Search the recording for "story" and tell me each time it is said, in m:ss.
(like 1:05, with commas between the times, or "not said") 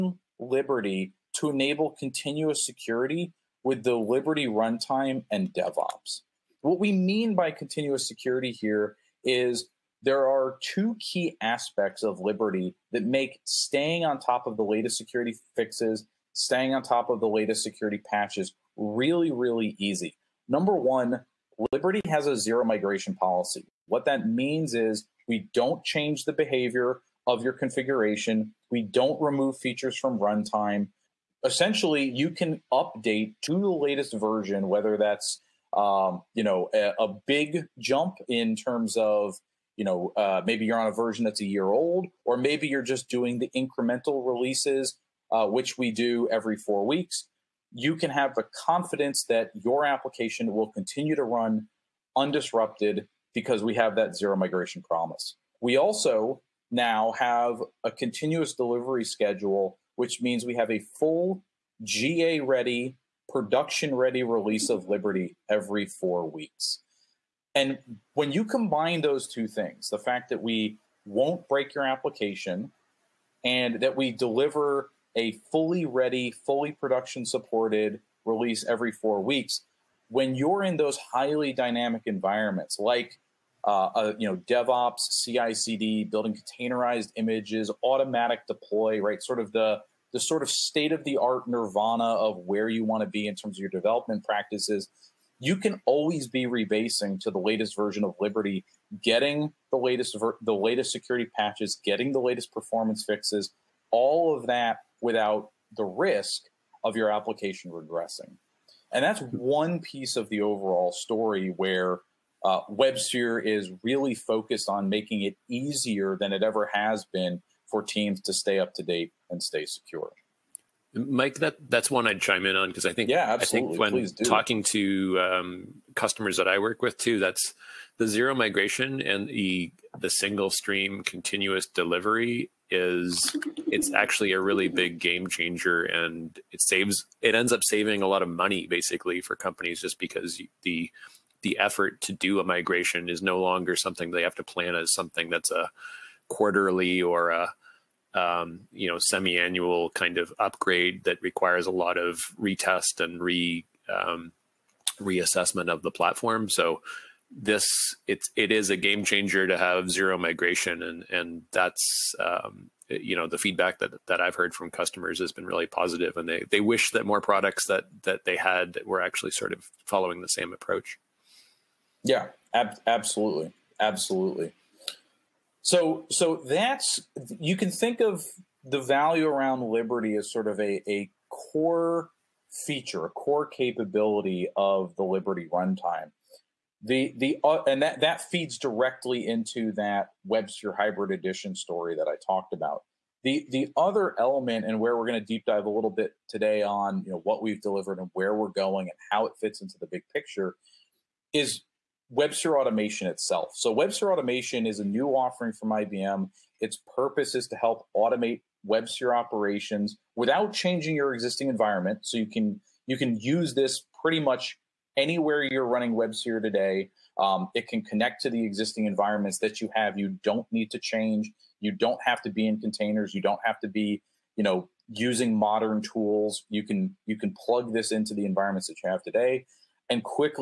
1:50, 3:11.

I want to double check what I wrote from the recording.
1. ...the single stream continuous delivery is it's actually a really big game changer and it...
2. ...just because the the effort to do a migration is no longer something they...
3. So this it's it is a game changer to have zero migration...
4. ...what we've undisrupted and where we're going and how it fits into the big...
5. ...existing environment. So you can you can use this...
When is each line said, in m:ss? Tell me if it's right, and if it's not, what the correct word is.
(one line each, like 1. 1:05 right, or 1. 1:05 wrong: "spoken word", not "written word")
1. 2:09 right
2. 2:19 right
3. 2:36 right
4. 3:17 wrong: "delivered", not "undisrupted"
5. 3:31 right.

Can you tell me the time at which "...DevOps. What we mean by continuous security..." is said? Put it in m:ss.
0:05.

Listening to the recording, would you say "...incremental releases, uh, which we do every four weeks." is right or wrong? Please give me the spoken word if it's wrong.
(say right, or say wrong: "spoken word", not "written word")
right.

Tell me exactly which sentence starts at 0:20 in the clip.
Number one, Liberty has a zero migration policy.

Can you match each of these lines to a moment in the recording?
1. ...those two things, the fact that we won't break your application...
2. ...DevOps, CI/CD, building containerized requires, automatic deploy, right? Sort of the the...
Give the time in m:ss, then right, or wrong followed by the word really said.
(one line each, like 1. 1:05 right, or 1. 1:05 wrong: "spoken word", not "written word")
1. 1:09 right
2. 1:24 wrong: "images", not "requires".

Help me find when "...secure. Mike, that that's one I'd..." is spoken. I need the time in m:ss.
1:59.